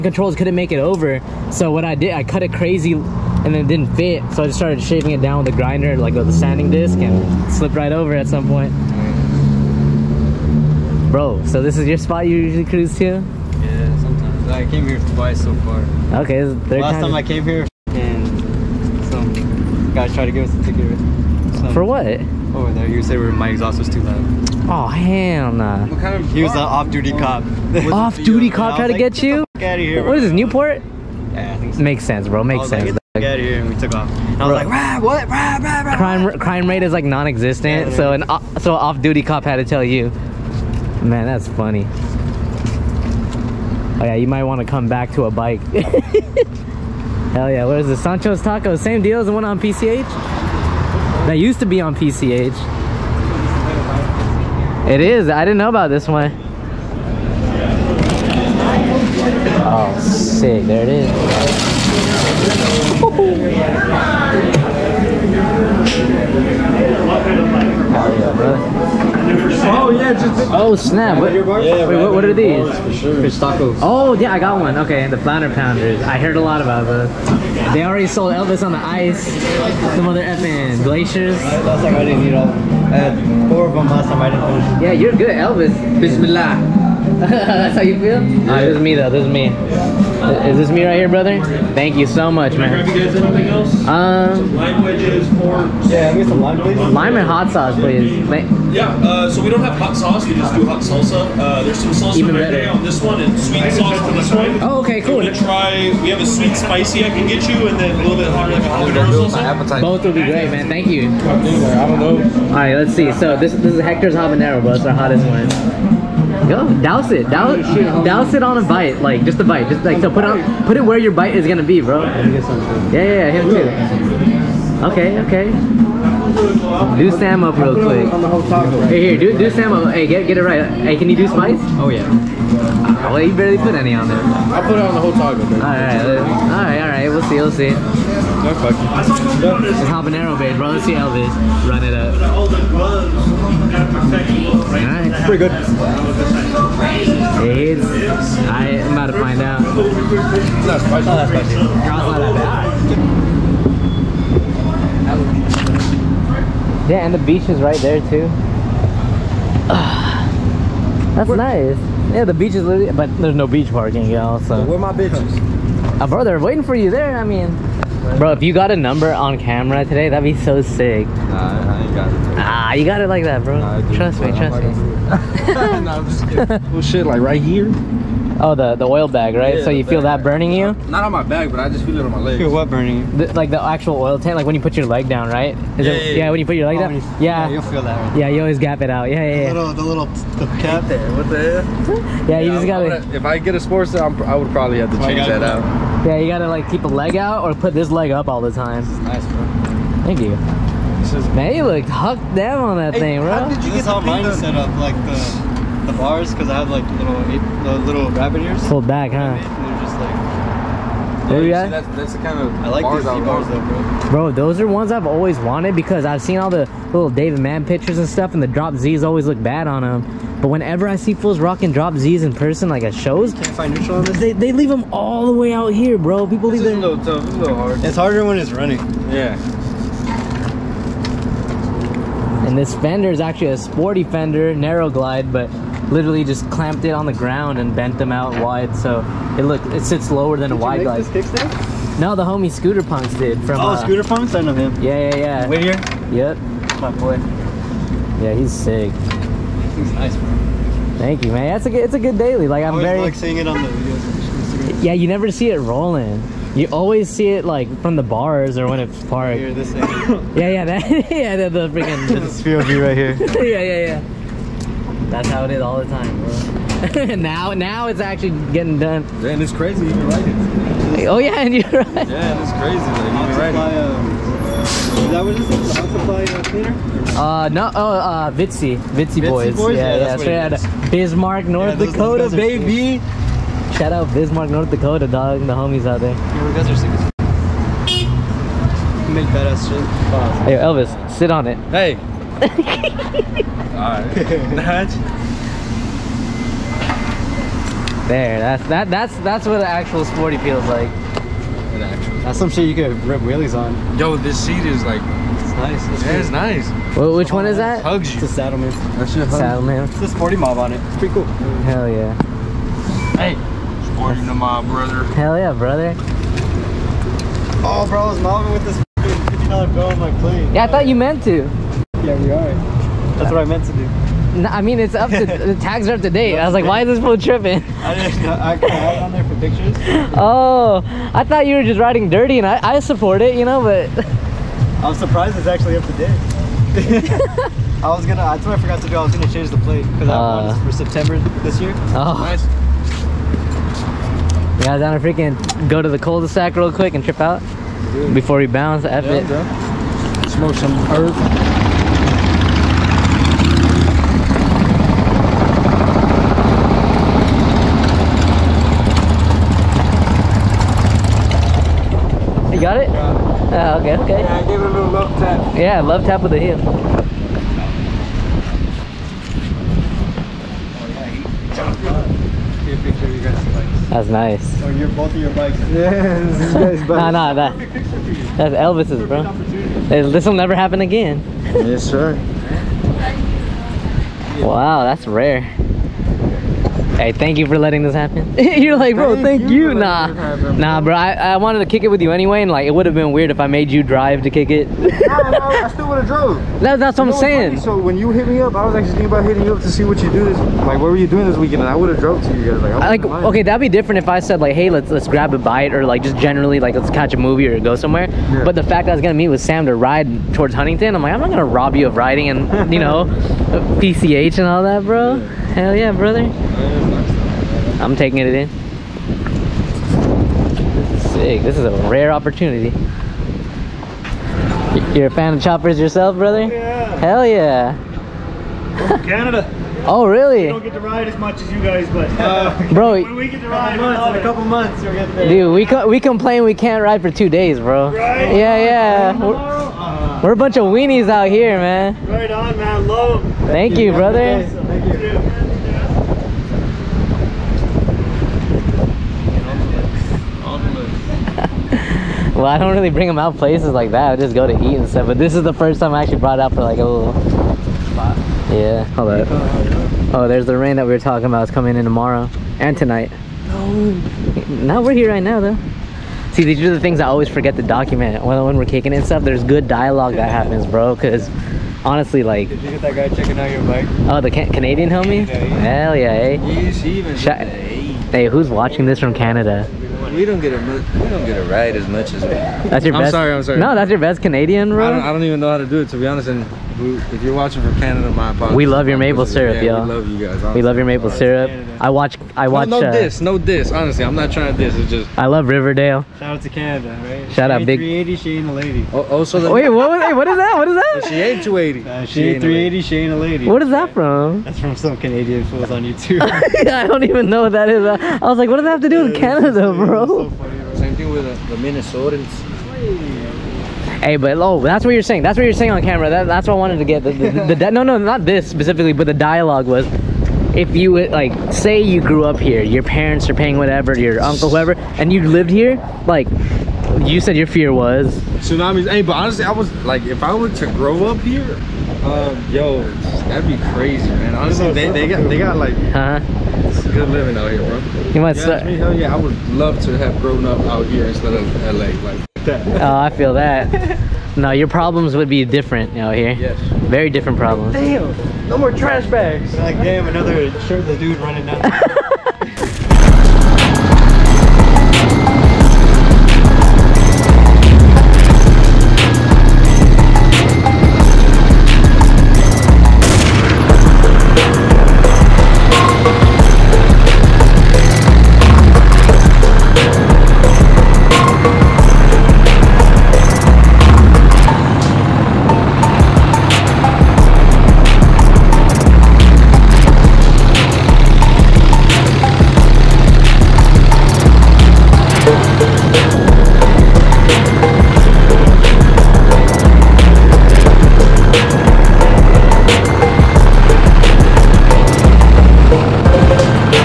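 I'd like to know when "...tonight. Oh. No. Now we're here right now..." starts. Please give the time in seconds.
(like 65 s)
462 s.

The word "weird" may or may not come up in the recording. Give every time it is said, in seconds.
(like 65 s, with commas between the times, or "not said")
393 s.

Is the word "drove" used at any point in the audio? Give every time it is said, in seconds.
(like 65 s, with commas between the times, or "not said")
396 s, 401 s.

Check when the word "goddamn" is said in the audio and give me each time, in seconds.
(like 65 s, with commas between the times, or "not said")
not said.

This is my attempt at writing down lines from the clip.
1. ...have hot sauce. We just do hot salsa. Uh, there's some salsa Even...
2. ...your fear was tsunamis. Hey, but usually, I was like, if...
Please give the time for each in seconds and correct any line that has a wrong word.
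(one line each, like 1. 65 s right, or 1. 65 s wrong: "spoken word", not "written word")
1. 99 s right
2. 527 s wrong: "honestly", not "usually".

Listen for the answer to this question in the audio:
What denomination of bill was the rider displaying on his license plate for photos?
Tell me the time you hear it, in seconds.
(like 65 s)
318 s.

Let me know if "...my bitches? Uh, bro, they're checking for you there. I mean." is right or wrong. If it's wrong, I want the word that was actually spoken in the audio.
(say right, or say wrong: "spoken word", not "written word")
wrong: "waiting", not "checking".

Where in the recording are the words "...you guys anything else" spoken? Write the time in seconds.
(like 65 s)
92 s.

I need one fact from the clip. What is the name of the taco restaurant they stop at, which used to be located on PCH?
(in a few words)
Sancho's Tacos.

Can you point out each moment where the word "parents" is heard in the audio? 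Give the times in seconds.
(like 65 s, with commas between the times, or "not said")
522 s.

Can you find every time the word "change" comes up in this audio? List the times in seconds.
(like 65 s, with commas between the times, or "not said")
194 s, 339 s.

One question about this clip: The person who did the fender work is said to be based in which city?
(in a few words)
Whittier.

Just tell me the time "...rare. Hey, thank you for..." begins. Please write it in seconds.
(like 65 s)
385 s.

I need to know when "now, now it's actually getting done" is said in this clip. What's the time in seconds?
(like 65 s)
267 s.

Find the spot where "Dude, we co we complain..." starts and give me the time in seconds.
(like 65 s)
435 s.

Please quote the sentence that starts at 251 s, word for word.
That's a good, it's a good daily.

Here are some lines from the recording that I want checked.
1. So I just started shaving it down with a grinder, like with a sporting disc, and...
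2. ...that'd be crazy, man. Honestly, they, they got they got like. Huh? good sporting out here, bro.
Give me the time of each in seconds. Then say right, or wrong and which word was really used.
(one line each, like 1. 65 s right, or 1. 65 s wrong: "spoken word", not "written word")
1. 4 s wrong: "sanding", not "sporting"
2. 533 s wrong: "living", not "sporting".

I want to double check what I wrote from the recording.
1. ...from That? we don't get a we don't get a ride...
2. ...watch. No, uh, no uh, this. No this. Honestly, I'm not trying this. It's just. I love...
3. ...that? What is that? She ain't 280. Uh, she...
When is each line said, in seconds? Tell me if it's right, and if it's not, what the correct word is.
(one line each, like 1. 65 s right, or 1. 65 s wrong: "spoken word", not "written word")
1. 478 s wrong: "Canada", not "That"
2. 492 s right
3. 500 s right.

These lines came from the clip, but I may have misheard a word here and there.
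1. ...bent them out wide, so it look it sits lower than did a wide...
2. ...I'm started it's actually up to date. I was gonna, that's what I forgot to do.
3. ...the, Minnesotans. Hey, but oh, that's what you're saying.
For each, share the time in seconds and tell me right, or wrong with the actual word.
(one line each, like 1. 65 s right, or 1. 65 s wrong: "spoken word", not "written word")
1. 237 s right
2. 334 s wrong: "surprised", not "started"
3. 511 s right.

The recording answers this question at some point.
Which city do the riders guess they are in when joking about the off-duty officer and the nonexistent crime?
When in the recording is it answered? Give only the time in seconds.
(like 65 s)
30 s.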